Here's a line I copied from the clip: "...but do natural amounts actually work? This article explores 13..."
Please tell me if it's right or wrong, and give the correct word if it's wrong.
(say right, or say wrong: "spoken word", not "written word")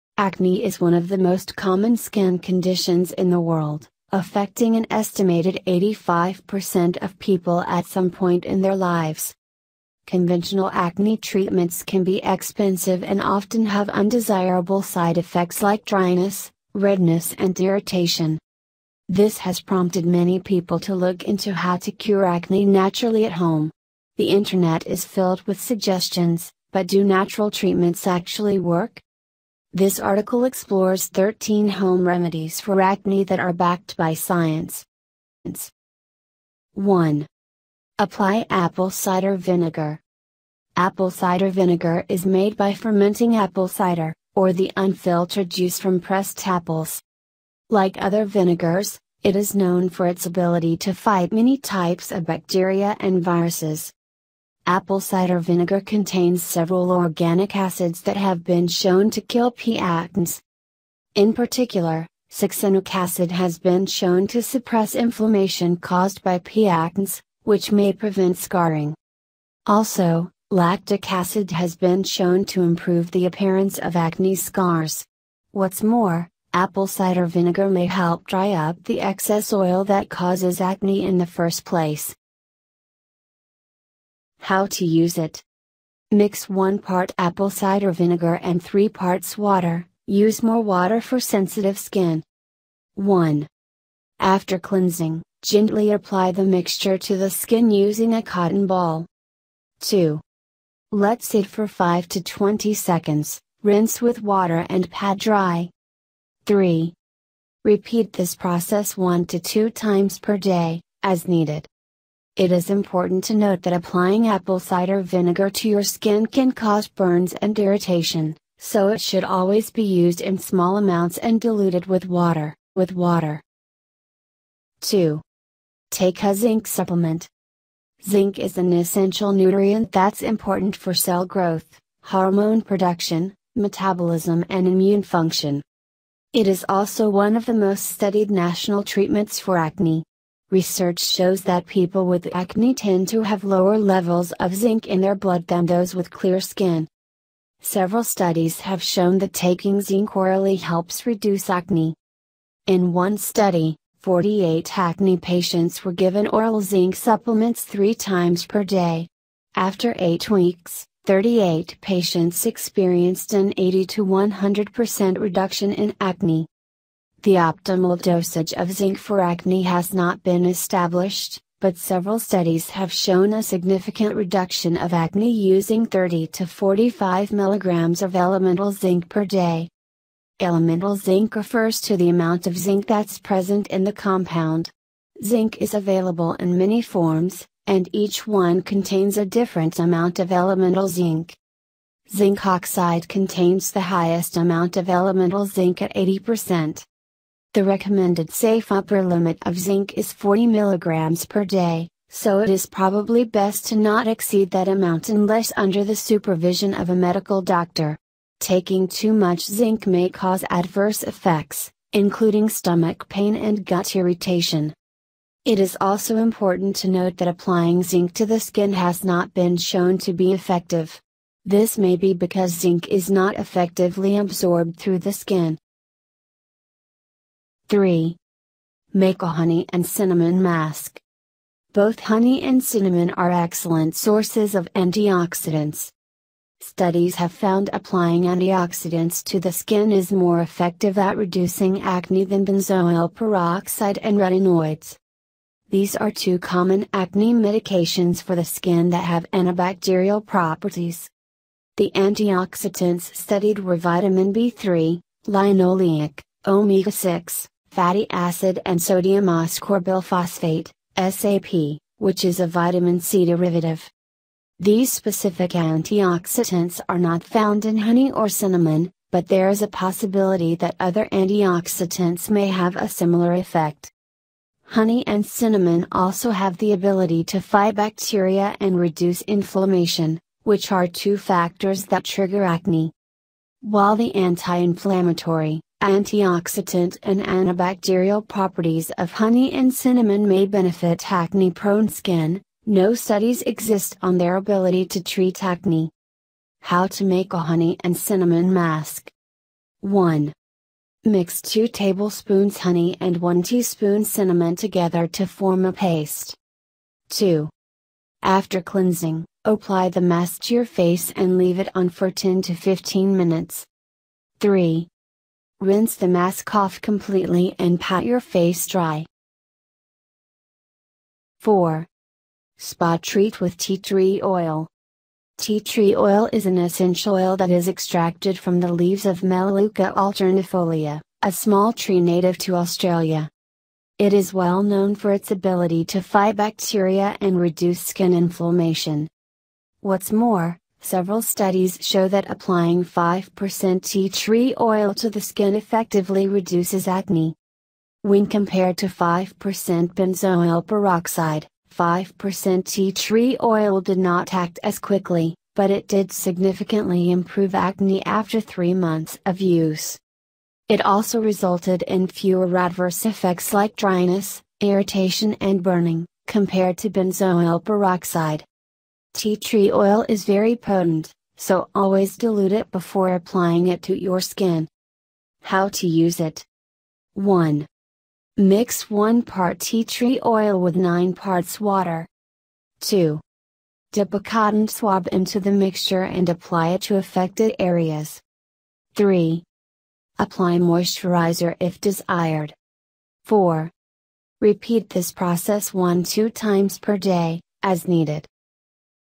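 wrong: "treatments", not "amounts".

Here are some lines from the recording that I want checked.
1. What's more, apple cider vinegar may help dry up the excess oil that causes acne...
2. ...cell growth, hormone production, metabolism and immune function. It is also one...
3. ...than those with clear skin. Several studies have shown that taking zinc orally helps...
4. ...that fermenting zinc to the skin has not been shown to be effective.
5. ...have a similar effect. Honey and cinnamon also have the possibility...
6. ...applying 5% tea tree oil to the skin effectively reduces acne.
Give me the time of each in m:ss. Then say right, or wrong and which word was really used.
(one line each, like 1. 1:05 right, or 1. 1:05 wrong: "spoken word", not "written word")
1. 1:15 right
2. 2:10 right
3. 2:25 right
4. 3:37 wrong: "applying", not "fermenting"
5. 4:32 wrong: "ability", not "possibility"
6. 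5:42 right.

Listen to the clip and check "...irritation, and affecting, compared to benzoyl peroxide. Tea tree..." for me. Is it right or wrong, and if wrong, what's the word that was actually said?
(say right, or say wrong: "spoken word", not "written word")
wrong: "burning", not "affecting".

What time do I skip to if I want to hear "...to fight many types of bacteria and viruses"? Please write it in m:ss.
0:50.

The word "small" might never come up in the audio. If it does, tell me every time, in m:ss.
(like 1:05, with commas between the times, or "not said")
2:00, 5:31.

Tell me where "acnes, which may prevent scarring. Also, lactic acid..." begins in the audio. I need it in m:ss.
1:06.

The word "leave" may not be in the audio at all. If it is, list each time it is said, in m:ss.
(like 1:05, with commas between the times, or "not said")
5:11, 5:28.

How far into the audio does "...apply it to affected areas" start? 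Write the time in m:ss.
6:26.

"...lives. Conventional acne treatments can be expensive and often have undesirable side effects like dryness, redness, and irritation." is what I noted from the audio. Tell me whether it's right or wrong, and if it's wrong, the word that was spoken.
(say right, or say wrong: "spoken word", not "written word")
right.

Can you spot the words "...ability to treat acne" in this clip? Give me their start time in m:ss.
4:54.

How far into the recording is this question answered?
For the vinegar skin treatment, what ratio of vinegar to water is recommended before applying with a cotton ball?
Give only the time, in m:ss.
1:26.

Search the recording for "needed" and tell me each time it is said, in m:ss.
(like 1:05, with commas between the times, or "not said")
1:51, 6:37.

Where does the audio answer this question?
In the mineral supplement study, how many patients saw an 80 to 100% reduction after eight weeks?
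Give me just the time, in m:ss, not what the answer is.
2:41.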